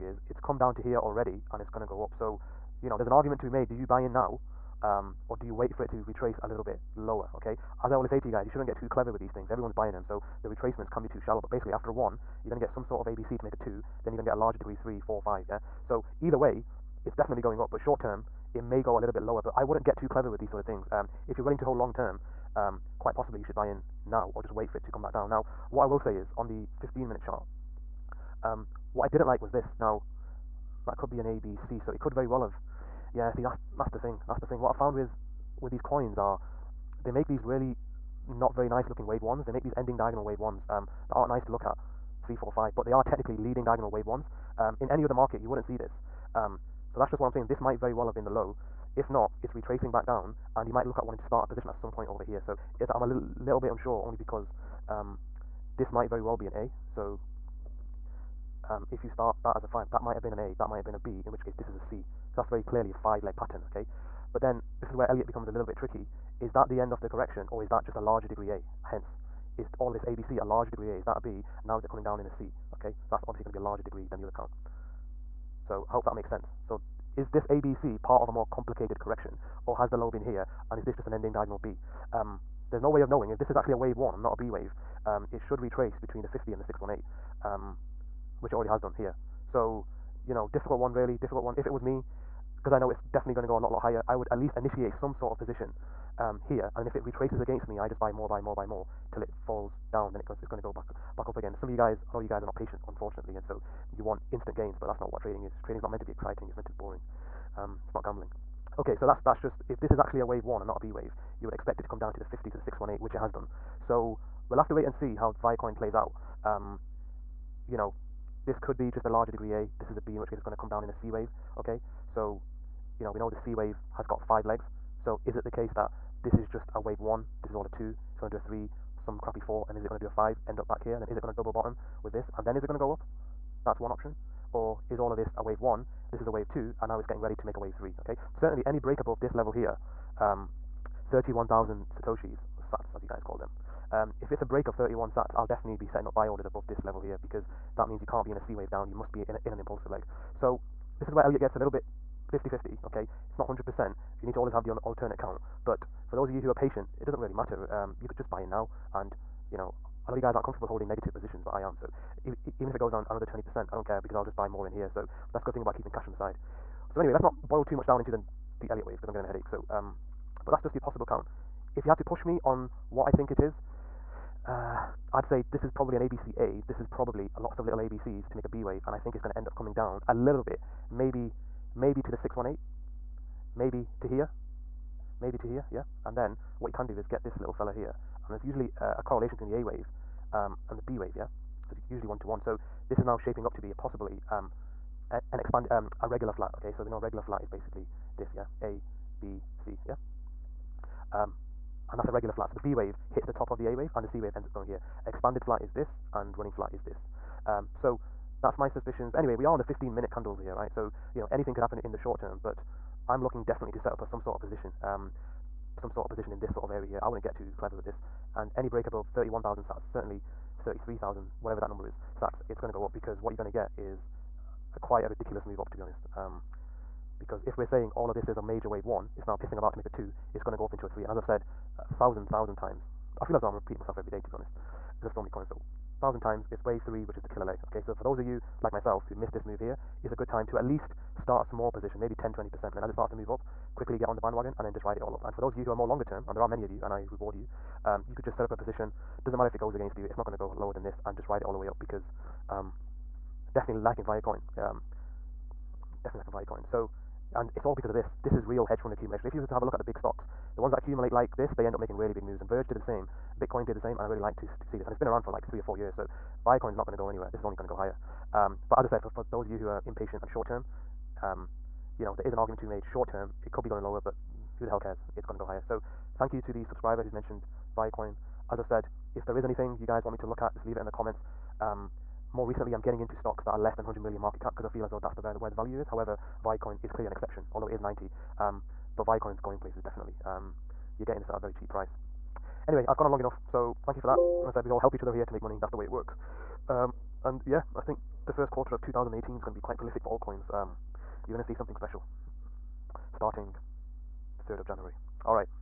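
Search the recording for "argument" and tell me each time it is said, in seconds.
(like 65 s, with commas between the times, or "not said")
3 s, 272 s.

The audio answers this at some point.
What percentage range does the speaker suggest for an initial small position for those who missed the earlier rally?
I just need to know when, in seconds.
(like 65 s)
242 s.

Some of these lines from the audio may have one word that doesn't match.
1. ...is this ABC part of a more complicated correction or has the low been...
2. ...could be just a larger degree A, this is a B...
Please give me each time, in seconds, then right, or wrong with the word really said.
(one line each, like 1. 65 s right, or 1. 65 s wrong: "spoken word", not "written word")
1. 77 s right
2. 118 s right.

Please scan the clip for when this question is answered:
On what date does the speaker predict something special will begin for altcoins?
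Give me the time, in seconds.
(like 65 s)
304 s.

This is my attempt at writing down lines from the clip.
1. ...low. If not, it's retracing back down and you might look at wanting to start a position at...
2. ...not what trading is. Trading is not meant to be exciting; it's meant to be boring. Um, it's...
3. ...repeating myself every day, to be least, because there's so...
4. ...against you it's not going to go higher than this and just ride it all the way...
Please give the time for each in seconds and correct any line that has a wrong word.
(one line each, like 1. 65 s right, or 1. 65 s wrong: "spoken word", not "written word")
1. 48 s right
2. 105 s right
3. 233 s wrong: "honest", not "least"
4. 249 s wrong: "lower", not "higher".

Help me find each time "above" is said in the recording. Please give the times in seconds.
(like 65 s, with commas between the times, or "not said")
139 s, 146 s, 218 s.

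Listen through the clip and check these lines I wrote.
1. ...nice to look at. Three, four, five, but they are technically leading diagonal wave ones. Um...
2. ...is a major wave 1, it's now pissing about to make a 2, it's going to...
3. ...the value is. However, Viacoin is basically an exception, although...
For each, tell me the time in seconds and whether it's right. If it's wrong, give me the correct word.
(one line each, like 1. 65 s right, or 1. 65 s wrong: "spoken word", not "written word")
1. 41 s right
2. 228 s right
3. 285 s wrong: "clearly", not "basically".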